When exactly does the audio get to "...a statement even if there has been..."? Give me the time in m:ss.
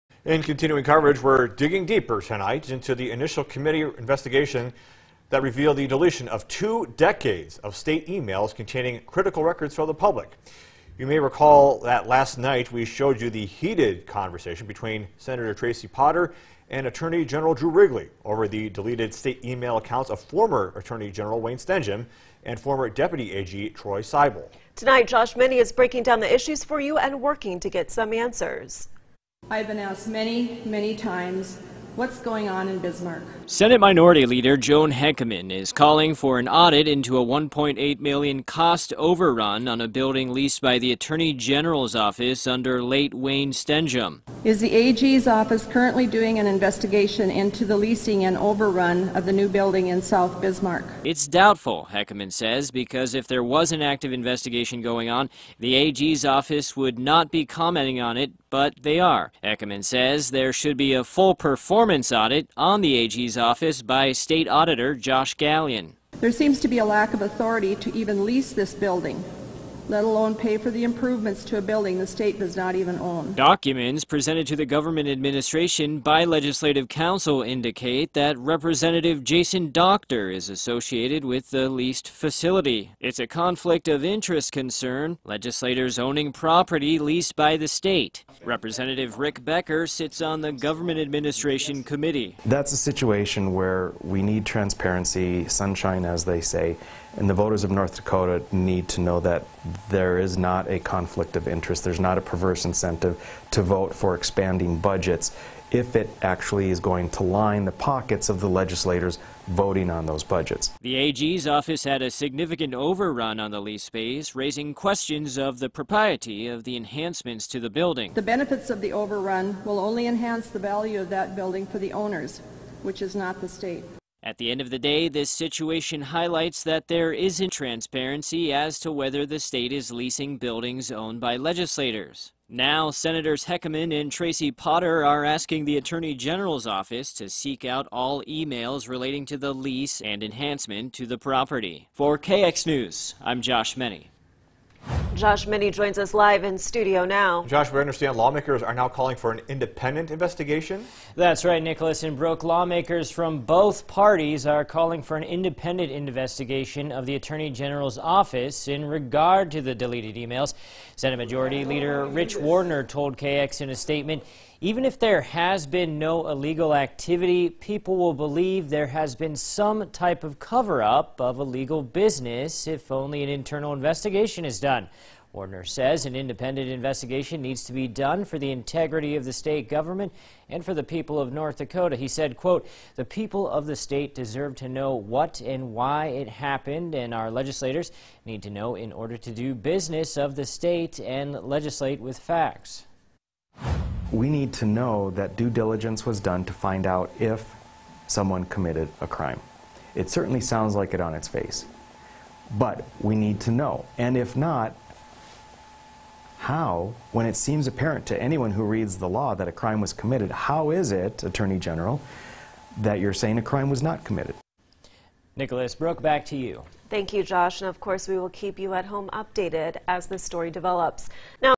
2:43.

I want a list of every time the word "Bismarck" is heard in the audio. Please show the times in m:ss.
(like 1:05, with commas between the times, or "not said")
0:32, 0:50.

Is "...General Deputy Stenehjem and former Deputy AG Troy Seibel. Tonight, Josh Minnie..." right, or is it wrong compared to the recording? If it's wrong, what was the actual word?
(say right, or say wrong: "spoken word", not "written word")
wrong: "Wayne", not "Deputy".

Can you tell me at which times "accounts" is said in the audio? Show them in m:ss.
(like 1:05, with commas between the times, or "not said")
0:19.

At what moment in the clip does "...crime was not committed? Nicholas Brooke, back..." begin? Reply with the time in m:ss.
3:33.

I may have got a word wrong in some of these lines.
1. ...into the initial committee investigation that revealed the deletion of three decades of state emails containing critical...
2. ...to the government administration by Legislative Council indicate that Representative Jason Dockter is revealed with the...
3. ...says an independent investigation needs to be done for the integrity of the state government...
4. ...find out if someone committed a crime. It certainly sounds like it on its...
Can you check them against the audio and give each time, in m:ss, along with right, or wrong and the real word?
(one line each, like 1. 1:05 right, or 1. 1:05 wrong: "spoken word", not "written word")
1. 0:02 wrong: "two", not "three"
2. 1:14 wrong: "associated", not "revealed"
3. 2:55 right
4. 3:16 right.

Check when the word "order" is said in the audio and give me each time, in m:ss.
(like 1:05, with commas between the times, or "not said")
3:08.